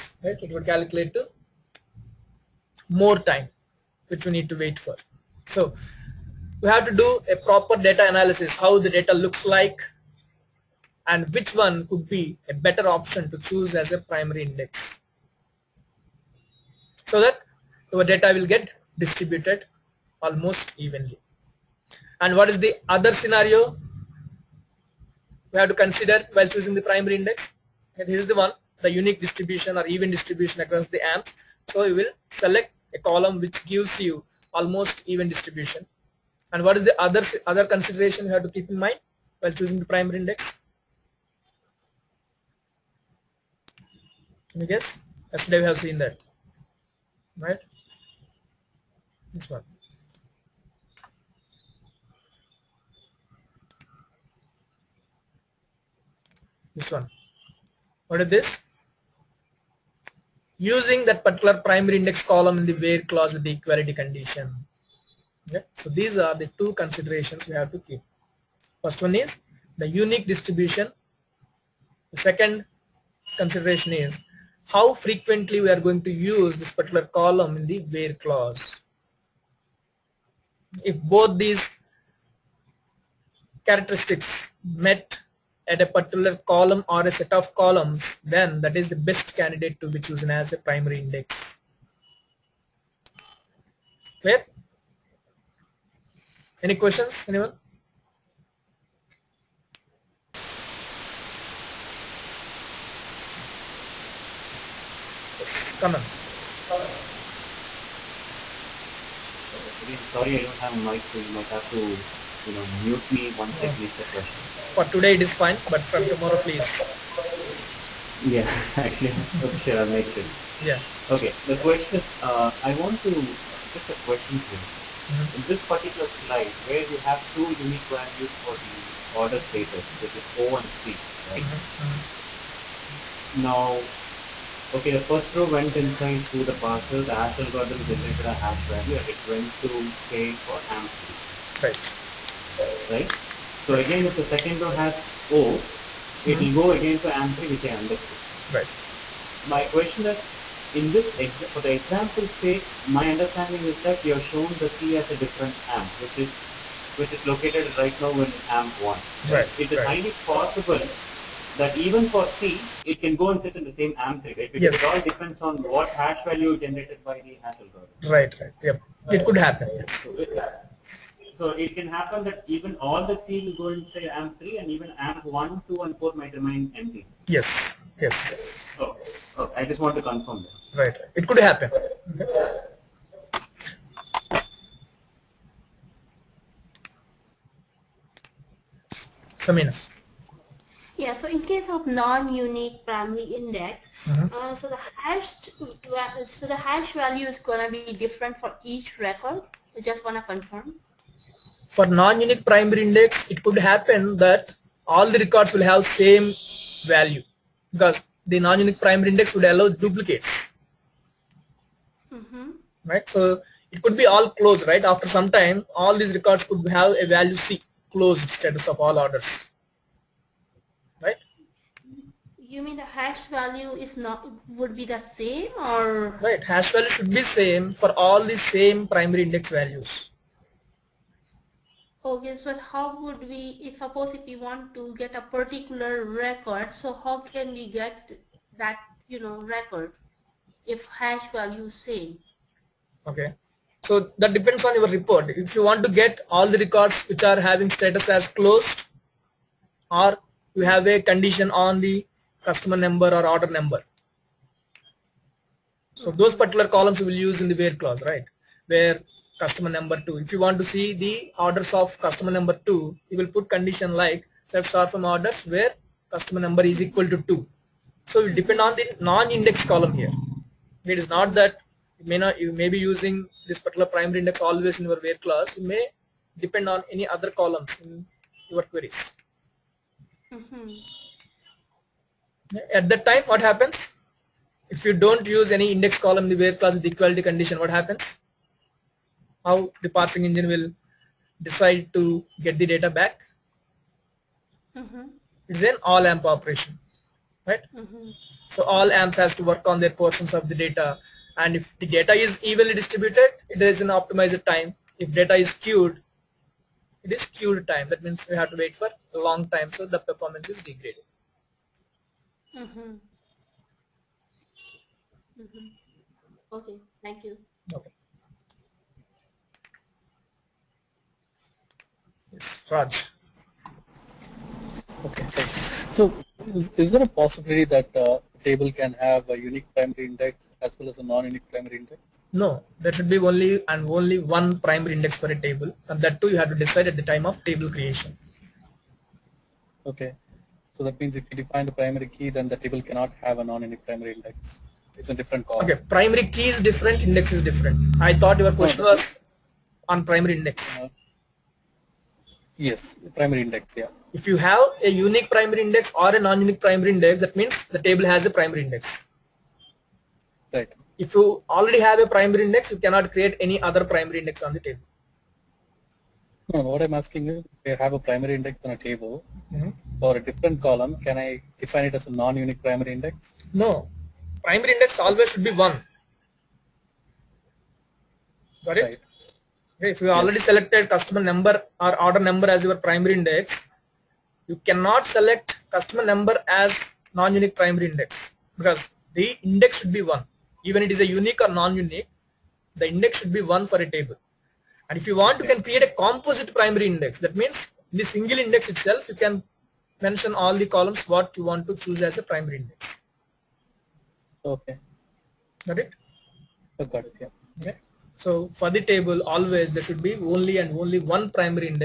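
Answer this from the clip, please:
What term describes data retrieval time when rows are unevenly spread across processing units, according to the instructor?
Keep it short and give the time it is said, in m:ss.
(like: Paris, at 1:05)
skewed time, at 5:07.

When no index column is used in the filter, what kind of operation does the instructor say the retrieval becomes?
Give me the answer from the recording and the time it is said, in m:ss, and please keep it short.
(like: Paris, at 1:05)
all AMP operation, at 4:55.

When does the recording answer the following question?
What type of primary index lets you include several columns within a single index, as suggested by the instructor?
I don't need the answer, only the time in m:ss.
6:36.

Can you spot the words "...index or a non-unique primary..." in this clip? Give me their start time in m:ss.
5:55.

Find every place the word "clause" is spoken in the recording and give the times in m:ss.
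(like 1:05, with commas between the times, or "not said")
1:02, 1:18, 4:17, 4:35, 4:46.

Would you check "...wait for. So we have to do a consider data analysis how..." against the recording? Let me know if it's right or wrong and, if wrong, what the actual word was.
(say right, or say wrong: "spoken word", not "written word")
wrong: "proper", not "consider".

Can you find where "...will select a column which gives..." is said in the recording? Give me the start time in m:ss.
0:31.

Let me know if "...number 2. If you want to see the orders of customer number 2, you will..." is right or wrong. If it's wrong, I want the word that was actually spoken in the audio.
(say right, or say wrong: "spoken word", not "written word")
right.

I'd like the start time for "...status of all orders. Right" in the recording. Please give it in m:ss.
3:38.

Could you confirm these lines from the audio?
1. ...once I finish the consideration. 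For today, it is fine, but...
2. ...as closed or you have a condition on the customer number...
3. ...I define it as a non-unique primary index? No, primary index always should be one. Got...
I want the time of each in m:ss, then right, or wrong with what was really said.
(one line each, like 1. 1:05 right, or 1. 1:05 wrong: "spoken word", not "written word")
1. 1:53 wrong: "question", not "consideration"
2. 4:08 right
3. 6:11 right.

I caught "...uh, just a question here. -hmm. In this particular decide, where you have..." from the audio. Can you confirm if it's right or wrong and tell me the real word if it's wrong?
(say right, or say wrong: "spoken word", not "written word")
wrong: "slide", not "decide".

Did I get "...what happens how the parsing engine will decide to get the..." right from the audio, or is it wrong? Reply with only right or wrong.
right.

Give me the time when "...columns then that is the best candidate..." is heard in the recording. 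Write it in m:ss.
1:27.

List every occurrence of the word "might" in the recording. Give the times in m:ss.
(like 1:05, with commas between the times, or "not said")
1:51, 2:56.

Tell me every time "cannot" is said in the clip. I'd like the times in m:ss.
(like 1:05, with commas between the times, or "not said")
5:42, 6:02, 6:24.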